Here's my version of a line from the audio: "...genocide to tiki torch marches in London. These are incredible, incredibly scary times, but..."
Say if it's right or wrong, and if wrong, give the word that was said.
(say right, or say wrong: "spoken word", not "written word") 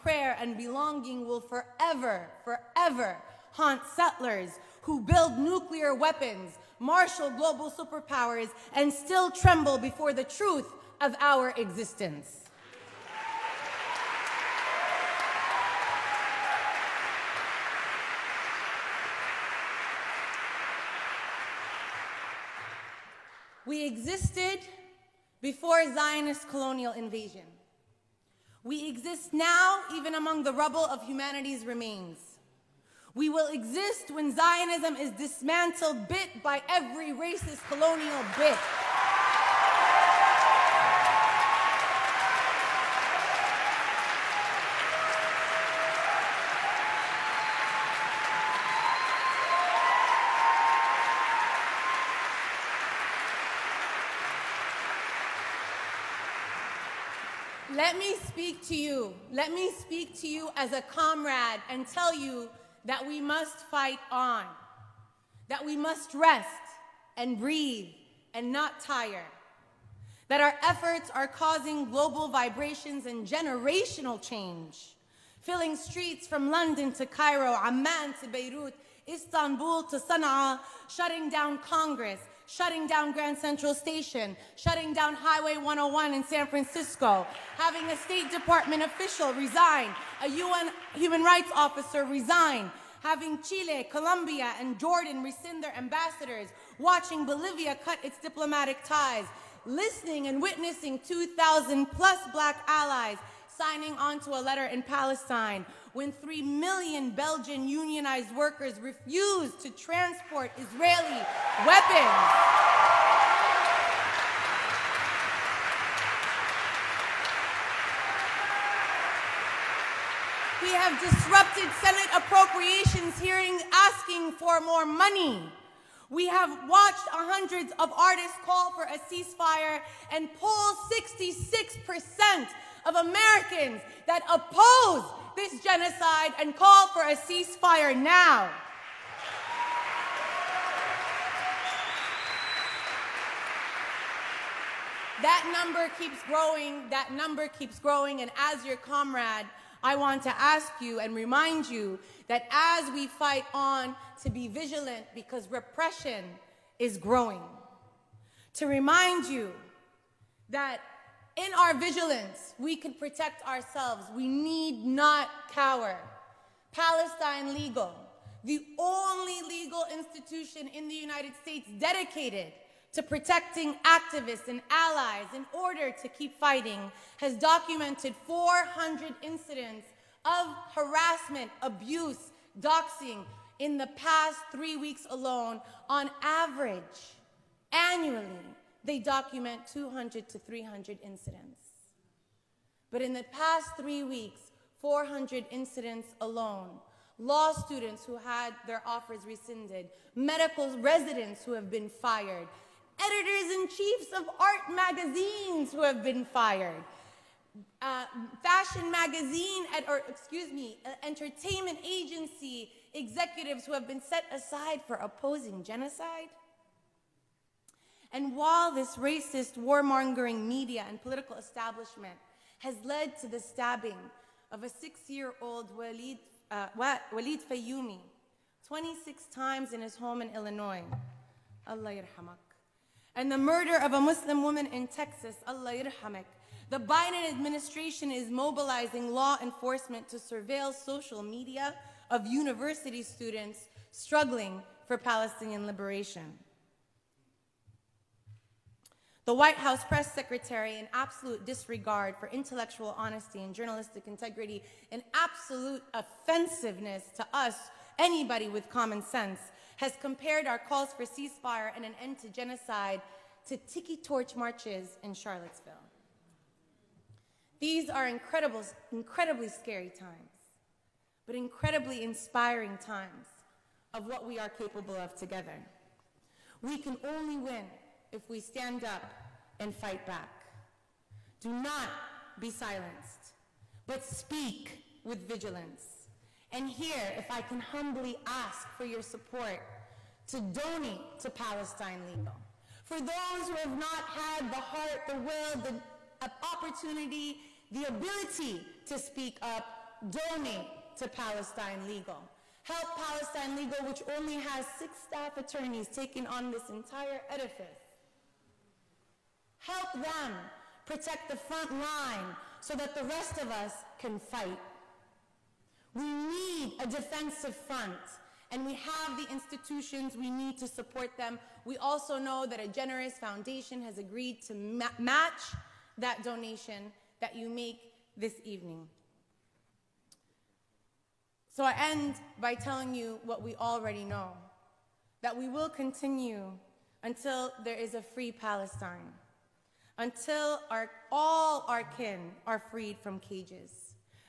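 wrong: "Charlottesville", not "London".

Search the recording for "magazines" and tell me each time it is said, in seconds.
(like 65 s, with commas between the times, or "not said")
204 s, 208 s.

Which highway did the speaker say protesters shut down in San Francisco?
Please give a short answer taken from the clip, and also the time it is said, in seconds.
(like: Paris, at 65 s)
Highway 101, at 85 s.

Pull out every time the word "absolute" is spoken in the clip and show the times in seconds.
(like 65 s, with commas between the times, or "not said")
250 s, 255 s.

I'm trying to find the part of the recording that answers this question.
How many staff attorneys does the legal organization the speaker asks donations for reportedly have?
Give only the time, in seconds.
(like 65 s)
304 s.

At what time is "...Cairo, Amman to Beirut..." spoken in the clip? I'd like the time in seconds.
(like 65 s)
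77 s.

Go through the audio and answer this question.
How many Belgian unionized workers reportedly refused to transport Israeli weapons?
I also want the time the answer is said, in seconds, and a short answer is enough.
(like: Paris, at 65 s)
3 million, at 106 s.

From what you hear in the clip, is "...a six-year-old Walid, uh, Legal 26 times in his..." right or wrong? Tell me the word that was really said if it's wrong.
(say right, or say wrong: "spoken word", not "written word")
wrong: "Walid", not "Legal".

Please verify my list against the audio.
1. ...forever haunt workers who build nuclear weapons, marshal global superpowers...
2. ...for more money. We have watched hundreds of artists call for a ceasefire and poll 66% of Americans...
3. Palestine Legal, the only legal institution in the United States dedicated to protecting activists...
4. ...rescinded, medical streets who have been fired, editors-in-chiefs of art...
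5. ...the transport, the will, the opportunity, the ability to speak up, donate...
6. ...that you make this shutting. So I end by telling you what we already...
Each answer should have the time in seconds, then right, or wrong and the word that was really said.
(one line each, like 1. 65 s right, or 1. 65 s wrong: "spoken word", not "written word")
1. 2 s wrong: "settlers", not "workers"
2. 124 s right
3. 166 s right
4. 199 s wrong: "residents", not "streets"
5. 294 s wrong: "heart", not "transport"
6. 327 s wrong: "evening", not "shutting".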